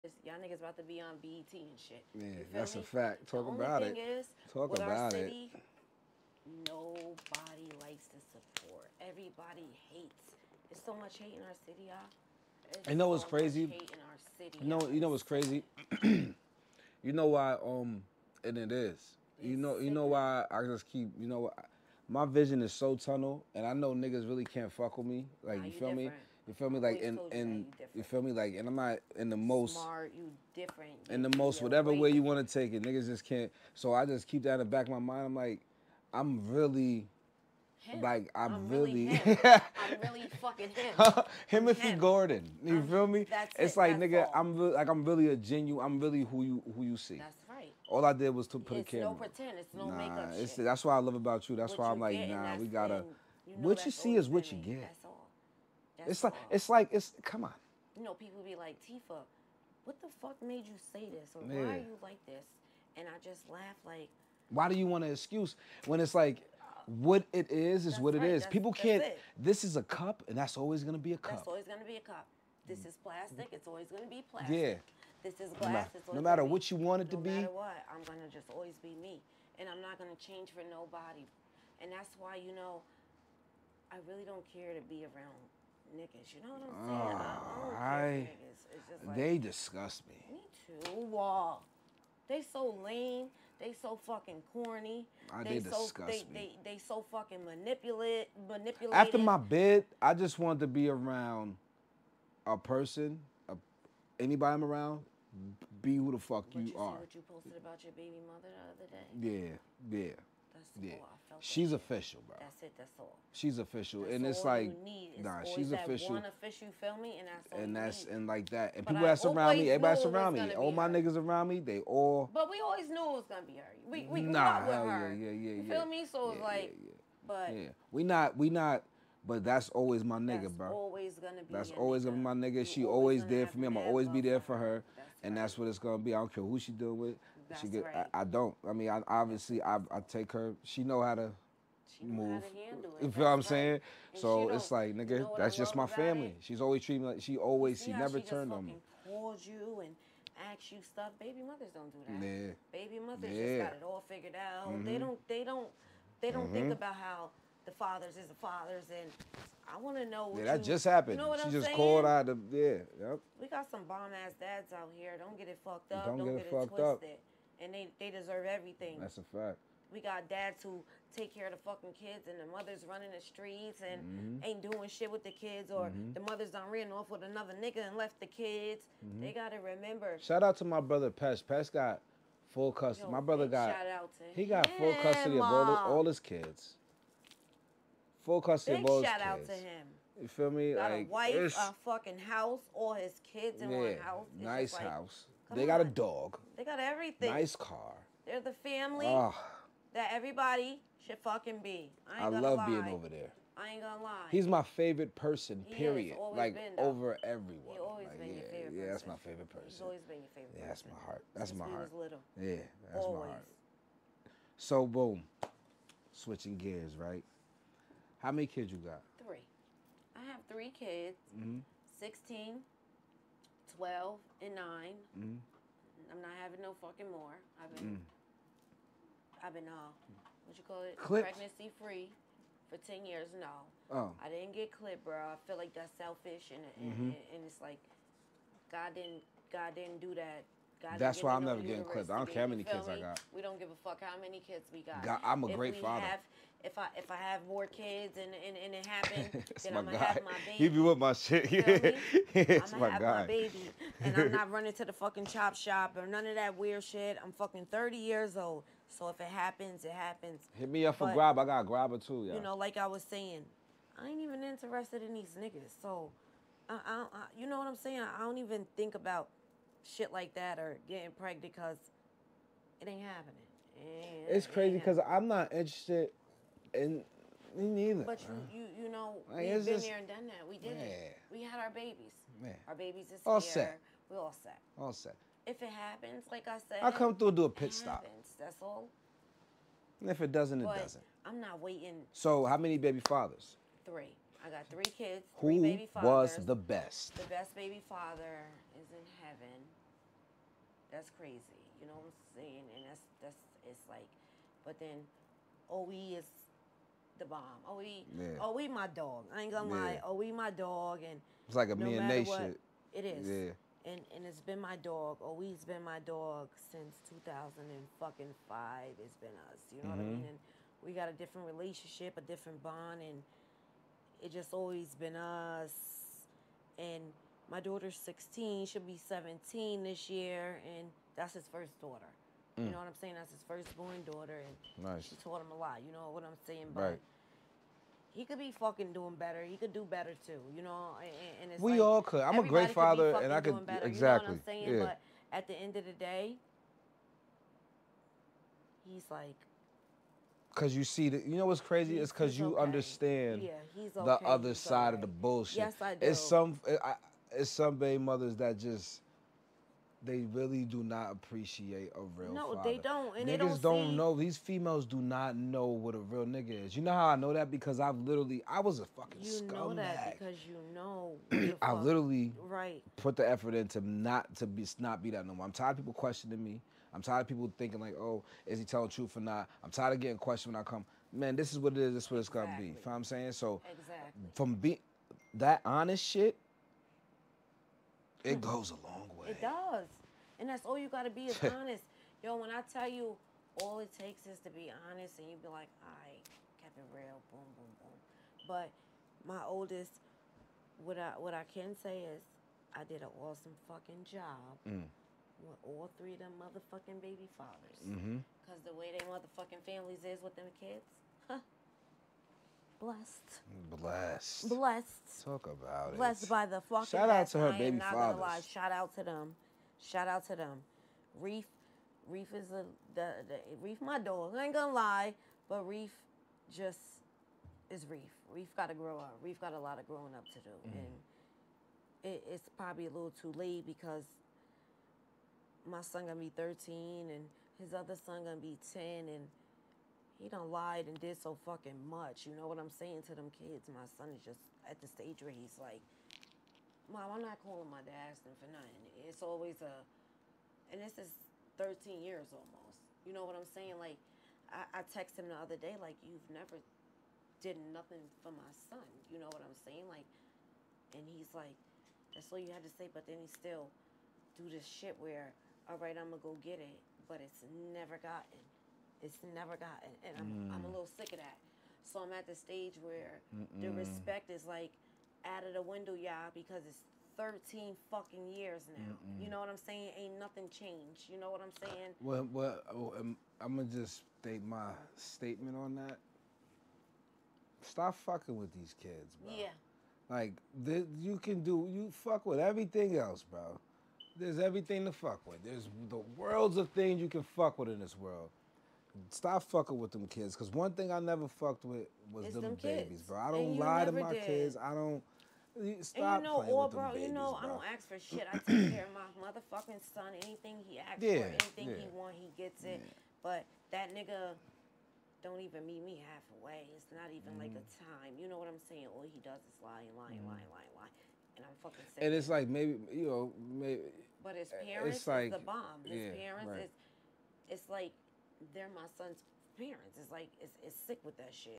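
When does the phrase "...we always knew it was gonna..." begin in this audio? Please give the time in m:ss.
2:02.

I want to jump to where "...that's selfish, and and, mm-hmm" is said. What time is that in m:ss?
3:55.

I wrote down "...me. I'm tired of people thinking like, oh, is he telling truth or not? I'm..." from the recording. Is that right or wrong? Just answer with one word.
right.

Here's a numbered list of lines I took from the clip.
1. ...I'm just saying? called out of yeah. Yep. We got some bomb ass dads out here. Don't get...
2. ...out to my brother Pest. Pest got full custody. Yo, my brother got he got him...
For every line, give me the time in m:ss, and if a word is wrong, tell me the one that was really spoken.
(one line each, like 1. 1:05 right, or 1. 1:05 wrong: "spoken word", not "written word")
1. 2:41 right
2. 3:00 right.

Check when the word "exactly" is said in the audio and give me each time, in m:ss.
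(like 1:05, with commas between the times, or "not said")
5:43, 6:23.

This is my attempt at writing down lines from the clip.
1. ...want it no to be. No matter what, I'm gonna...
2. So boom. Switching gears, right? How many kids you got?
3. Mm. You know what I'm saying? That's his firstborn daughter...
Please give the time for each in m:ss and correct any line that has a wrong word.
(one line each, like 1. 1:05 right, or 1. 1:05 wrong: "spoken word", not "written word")
1. 1:16 right
2. 3:34 right
3. 5:32 right.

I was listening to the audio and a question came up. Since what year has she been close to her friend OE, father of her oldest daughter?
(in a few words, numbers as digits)
2005.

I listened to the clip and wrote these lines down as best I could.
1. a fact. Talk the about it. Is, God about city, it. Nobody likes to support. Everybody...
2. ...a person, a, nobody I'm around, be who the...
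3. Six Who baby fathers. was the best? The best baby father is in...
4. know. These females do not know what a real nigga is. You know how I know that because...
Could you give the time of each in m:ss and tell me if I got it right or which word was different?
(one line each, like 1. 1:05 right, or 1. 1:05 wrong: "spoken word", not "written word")
1. 0:02 wrong: "Talk", not "God"
2. 1:42 wrong: "anybody", not "nobody"
3. 4:55 wrong: "Three", not "Six"
4. 6:03 right.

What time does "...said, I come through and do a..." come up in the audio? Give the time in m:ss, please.
4:46.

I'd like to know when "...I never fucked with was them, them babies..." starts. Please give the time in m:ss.
8:20.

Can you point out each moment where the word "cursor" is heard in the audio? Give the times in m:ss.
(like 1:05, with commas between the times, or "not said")
not said.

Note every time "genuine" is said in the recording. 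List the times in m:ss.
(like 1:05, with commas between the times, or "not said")
0:45.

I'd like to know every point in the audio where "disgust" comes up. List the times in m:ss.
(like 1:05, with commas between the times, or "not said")
1:29, 1:35.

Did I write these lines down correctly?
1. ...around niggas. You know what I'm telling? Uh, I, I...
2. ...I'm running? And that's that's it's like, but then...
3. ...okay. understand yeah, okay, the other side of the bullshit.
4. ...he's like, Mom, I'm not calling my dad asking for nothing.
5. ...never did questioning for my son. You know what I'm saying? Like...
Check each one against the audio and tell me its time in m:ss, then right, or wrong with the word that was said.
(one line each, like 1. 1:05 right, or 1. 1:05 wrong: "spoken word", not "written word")
1. 1:25 wrong: "saying", not "telling"
2. 5:02 wrong: "saying", not "running"
3. 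5:52 right
4. 7:25 right
5. 7:36 wrong: "nothing", not "questioning".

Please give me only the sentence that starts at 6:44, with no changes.
Mm want all three of them motherfucking baby fathers.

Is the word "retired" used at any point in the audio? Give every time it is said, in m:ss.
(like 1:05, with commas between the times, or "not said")
not said.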